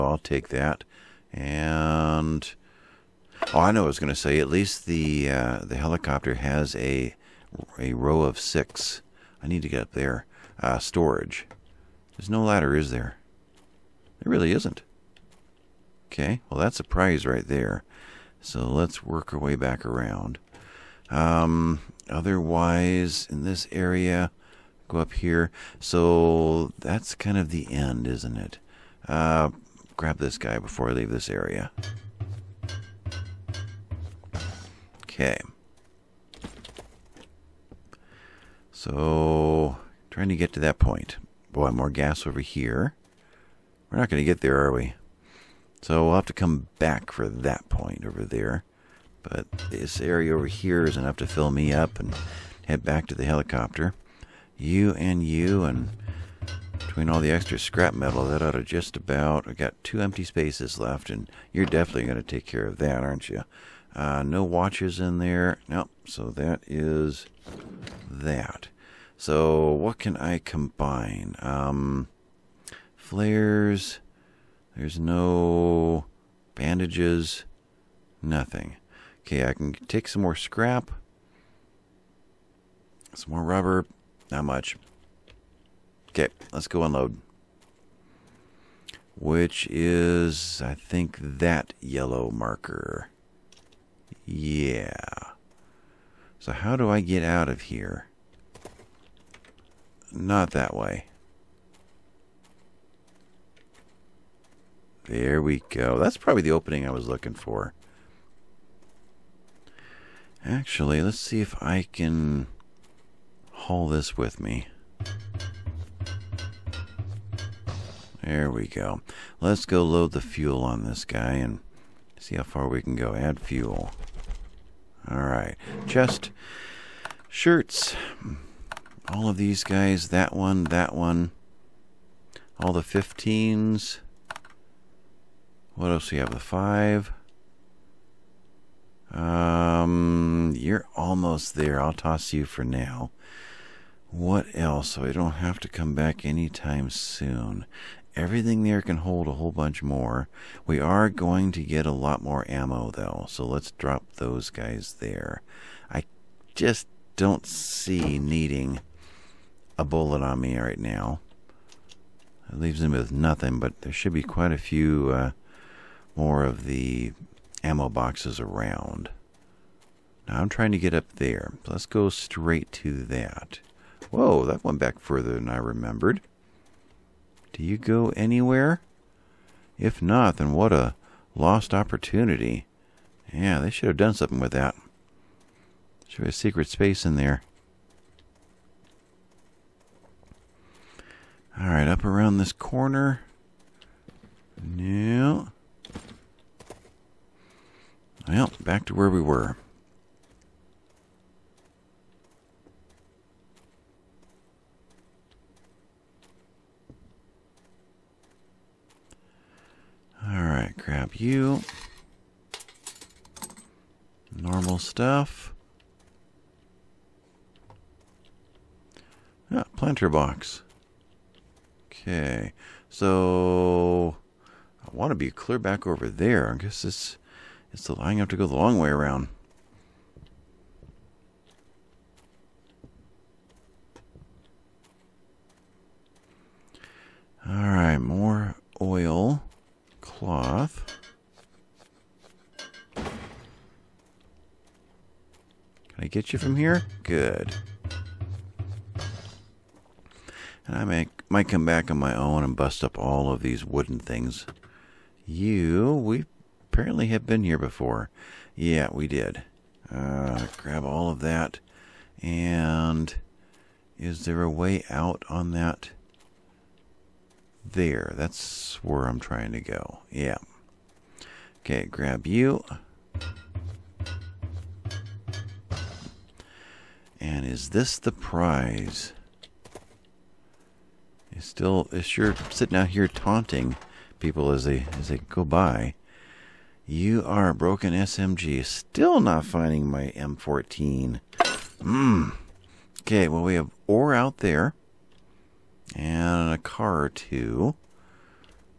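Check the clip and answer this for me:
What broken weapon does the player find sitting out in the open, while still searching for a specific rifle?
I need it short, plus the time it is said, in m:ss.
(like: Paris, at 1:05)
Broken SMG, at 4:47.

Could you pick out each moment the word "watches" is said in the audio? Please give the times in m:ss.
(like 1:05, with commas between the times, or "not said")
1:04.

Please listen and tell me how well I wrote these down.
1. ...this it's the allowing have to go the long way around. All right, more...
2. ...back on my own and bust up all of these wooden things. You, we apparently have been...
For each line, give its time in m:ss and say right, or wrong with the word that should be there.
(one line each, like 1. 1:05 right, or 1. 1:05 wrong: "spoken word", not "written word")
1. 3:46 right
2. 4:11 right.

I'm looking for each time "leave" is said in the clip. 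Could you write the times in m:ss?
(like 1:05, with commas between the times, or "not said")
0:30, 2:42.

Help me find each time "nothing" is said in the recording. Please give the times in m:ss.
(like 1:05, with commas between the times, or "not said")
1:18, 2:43.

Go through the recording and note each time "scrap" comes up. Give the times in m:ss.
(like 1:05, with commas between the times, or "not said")
0:57, 1:20.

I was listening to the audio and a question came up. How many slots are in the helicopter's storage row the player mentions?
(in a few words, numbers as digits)
6.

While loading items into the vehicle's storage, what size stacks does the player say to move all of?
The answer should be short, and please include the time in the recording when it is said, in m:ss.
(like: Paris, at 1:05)
15s, at 2:12.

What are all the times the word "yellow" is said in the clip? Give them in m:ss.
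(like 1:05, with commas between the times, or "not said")
1:31.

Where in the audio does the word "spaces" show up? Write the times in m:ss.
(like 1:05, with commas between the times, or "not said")
1:00, 3:06.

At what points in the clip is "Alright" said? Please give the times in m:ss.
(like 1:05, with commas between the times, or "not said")
2:05, 3:11, 3:30.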